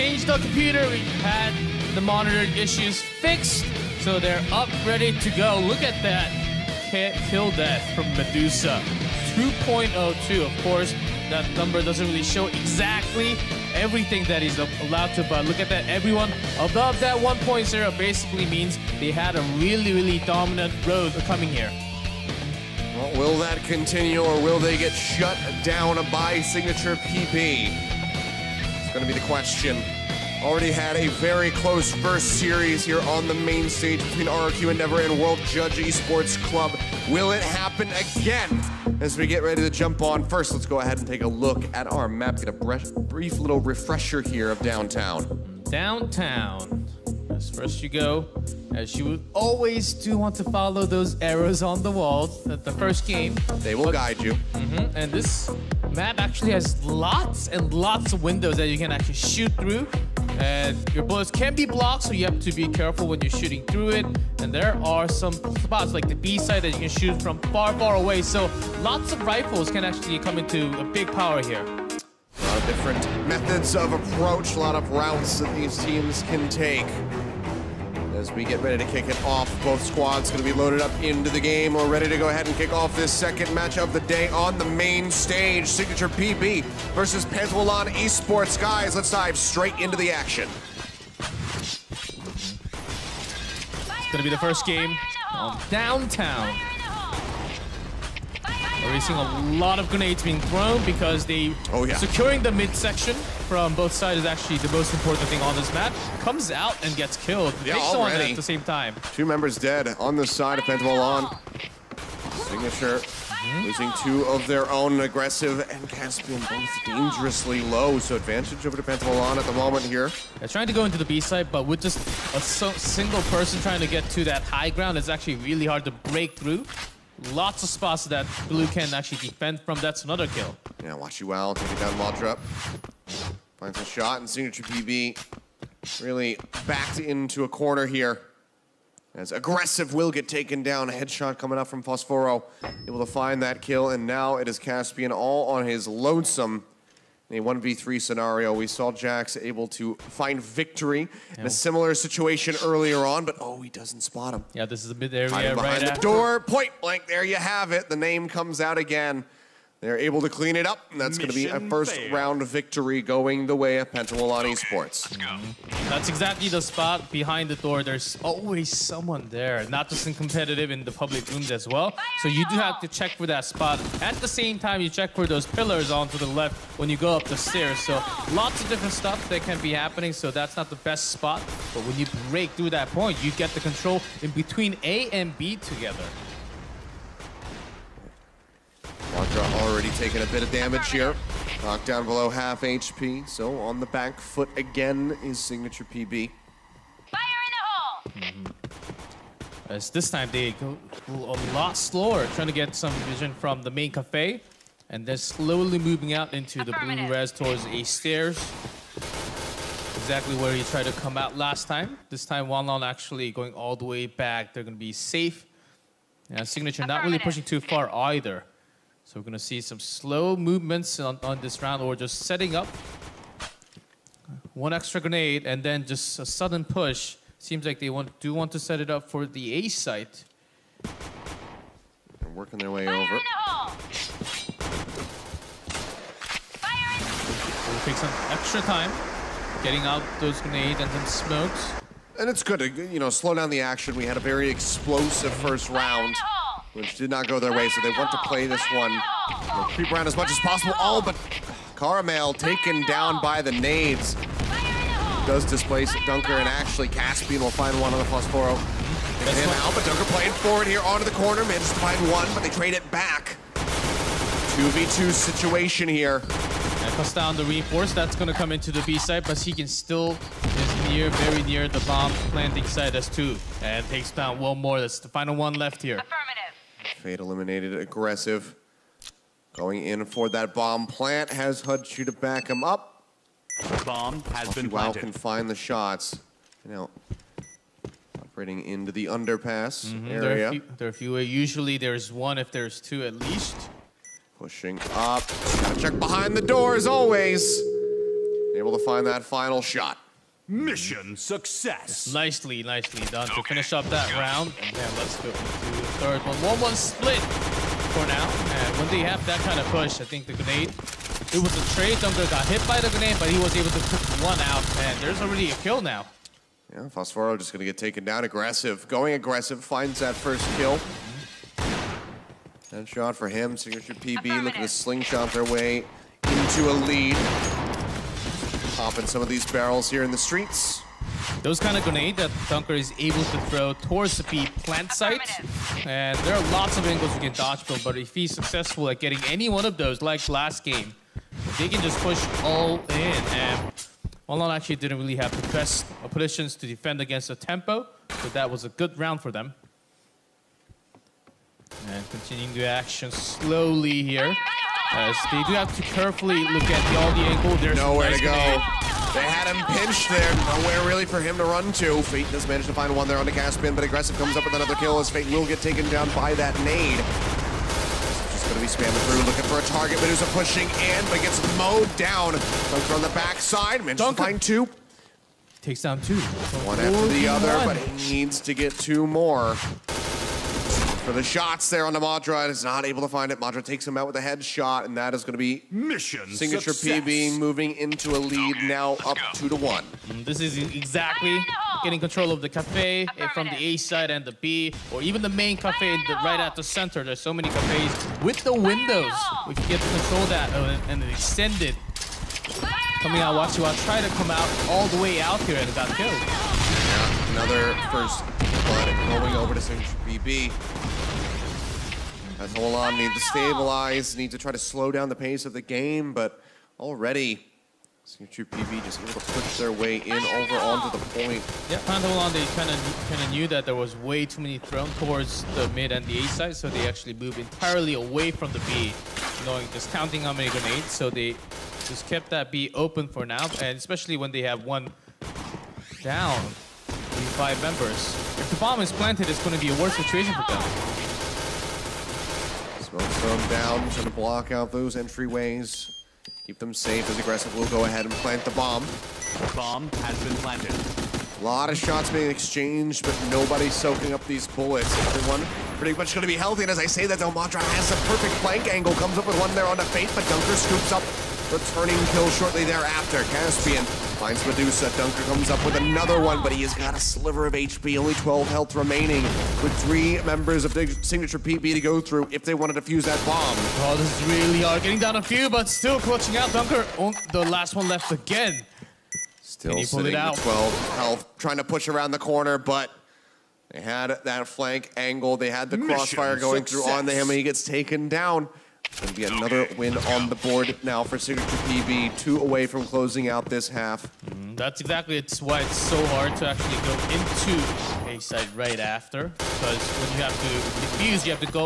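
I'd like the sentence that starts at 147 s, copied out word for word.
In a 1v3 scenario, we saw Jax able to find victory yeah.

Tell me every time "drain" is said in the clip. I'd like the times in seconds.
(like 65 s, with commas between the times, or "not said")
not said.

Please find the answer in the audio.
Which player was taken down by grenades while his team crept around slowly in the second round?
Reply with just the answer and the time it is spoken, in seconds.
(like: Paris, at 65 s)
Caramel, at 251 s.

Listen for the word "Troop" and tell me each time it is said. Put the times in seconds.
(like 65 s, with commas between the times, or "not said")
418 s.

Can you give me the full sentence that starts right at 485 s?
They had the Mission crossfire going success.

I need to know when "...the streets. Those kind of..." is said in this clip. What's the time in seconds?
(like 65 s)
330 s.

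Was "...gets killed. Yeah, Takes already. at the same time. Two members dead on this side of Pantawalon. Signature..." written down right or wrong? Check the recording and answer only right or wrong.
right.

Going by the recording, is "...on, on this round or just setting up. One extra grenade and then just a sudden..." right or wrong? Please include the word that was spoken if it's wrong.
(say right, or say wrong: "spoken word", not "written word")
right.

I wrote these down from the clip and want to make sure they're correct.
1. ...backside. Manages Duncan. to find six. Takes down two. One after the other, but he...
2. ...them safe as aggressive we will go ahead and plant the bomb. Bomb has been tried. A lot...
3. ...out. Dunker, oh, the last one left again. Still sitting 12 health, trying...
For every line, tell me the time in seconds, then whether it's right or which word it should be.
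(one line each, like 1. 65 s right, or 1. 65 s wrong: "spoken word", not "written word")
1. 373 s wrong: "two", not "six"
2. 446 s wrong: "planted", not "tried"
3. 476 s right.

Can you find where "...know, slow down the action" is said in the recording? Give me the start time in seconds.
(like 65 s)
242 s.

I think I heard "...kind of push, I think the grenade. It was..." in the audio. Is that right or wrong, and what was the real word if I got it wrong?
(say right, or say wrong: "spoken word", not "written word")
right.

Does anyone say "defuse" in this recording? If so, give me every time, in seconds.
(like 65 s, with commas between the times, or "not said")
472 s, 500 s.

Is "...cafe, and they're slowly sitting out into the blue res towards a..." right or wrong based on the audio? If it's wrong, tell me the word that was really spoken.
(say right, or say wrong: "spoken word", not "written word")
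wrong: "moving", not "sitting".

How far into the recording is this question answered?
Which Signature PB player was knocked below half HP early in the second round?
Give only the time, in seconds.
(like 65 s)
189 s.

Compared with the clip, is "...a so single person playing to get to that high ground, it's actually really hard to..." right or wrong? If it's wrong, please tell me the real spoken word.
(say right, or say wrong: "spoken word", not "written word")
wrong: "trying", not "playing".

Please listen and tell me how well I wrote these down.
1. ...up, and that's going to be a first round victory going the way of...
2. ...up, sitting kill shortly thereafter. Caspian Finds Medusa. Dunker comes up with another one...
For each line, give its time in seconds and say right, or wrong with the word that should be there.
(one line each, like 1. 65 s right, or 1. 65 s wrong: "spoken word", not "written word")
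1. 160 s right
2. 460 s wrong: "returning", not "sitting".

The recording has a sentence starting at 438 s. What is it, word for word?
If the bomb is planted, it's going to be a worse situation for them.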